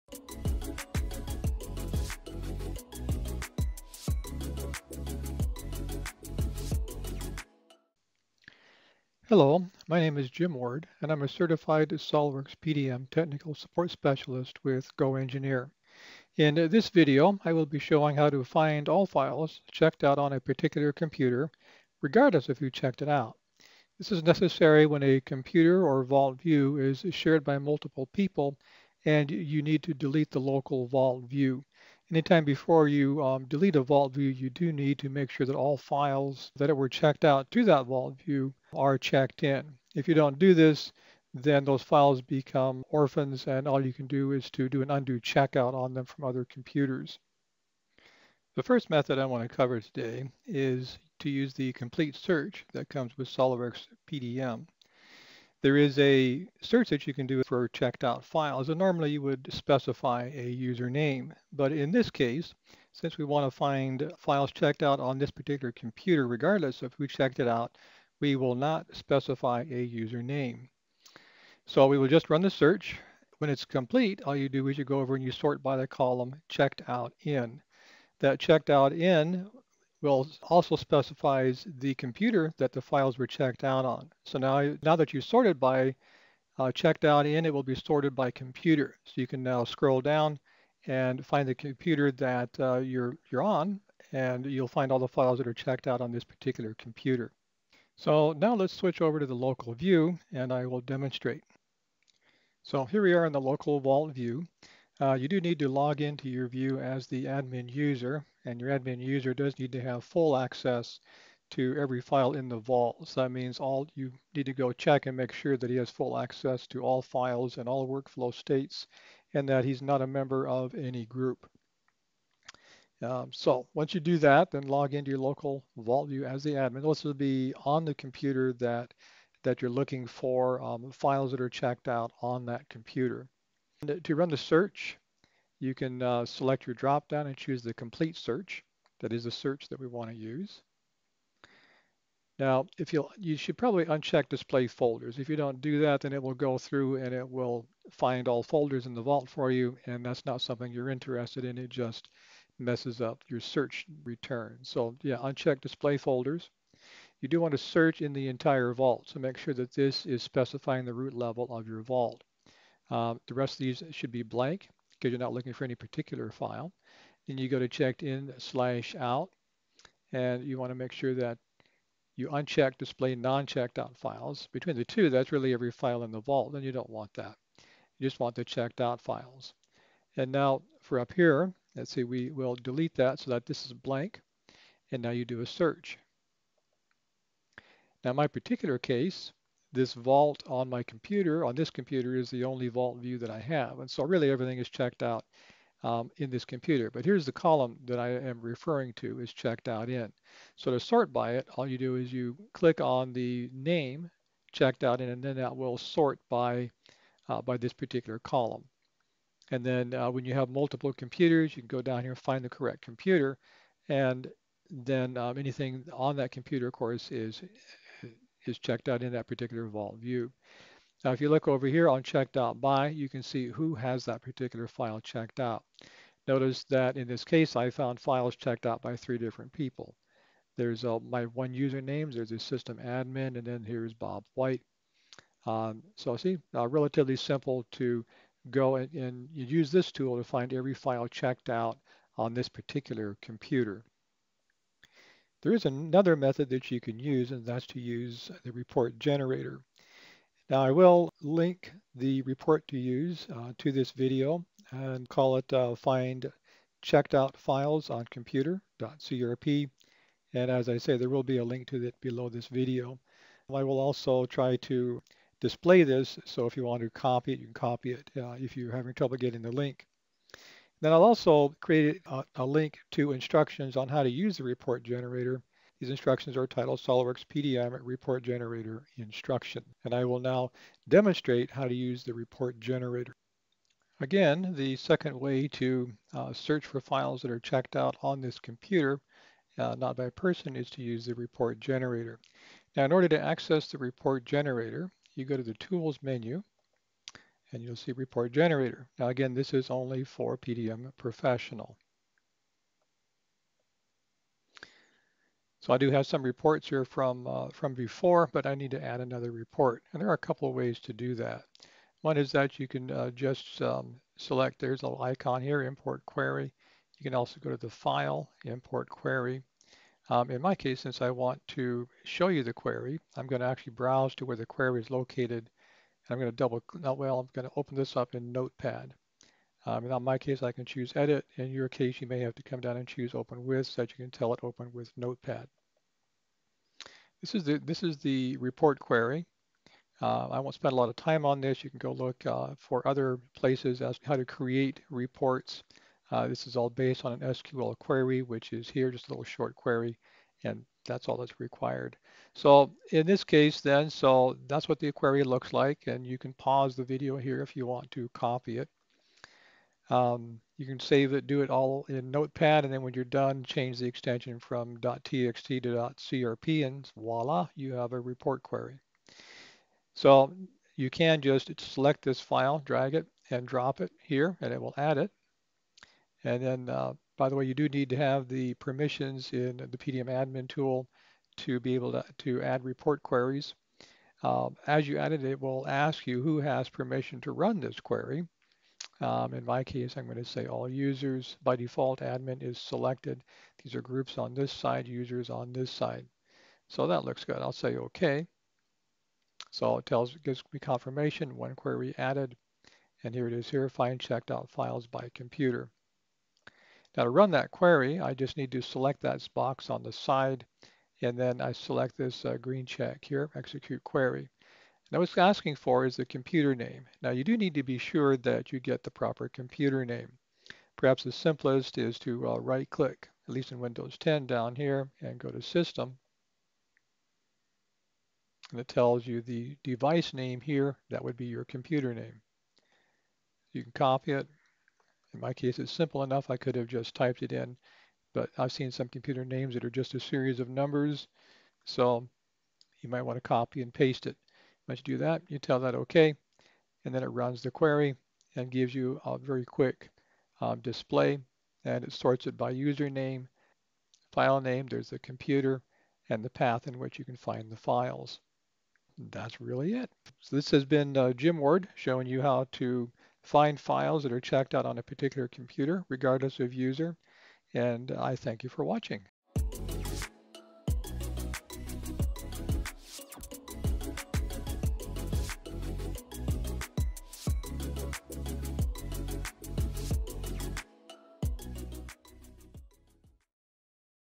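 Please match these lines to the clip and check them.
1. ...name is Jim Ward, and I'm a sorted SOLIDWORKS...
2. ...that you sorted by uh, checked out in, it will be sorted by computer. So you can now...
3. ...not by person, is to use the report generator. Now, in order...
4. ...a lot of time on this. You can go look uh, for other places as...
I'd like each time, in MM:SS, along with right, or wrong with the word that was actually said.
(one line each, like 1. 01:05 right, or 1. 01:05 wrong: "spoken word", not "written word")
1. 00:10 wrong: "certified", not "sorted"
2. 01:24 right
3. 04:49 right
4. 05:40 right.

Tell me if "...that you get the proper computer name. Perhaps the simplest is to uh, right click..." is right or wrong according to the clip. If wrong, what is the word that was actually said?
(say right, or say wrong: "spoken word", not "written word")
right.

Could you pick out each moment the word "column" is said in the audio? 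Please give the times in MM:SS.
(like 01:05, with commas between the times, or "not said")
01:15, 03:17, 03:28.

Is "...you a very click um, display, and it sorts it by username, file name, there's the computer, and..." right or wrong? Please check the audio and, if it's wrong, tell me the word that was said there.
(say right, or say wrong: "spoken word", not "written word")
wrong: "quick", not "click".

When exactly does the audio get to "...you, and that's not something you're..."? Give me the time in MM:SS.
02:29.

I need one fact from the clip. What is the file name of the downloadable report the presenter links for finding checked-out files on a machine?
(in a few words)
find checked out files on computer.crp.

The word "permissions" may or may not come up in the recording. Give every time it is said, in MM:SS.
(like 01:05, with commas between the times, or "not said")
06:18, 06:26.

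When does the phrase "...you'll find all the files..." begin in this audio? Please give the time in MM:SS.
01:34.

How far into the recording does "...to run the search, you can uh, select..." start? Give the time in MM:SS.
02:14.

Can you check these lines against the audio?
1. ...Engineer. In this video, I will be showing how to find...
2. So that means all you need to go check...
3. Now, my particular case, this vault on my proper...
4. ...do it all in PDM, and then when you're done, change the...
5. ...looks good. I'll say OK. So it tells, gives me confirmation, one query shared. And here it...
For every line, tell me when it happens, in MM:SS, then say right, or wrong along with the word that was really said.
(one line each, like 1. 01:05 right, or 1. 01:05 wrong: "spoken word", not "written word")
1. 00:15 right
2. 01:53 right
3. 03:08 wrong: "computer", not "proper"
4. 06:01 wrong: "Notepad", not "PDM"
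5. 06:37 wrong: "added", not "shared".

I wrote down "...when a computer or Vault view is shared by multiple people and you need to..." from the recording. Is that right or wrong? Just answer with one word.
right.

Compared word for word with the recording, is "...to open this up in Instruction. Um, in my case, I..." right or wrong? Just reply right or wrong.
wrong.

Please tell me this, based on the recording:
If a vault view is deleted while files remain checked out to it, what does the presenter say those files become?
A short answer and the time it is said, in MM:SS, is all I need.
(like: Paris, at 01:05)
Orphans, at 00:42.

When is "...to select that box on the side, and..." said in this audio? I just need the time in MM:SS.
06:48.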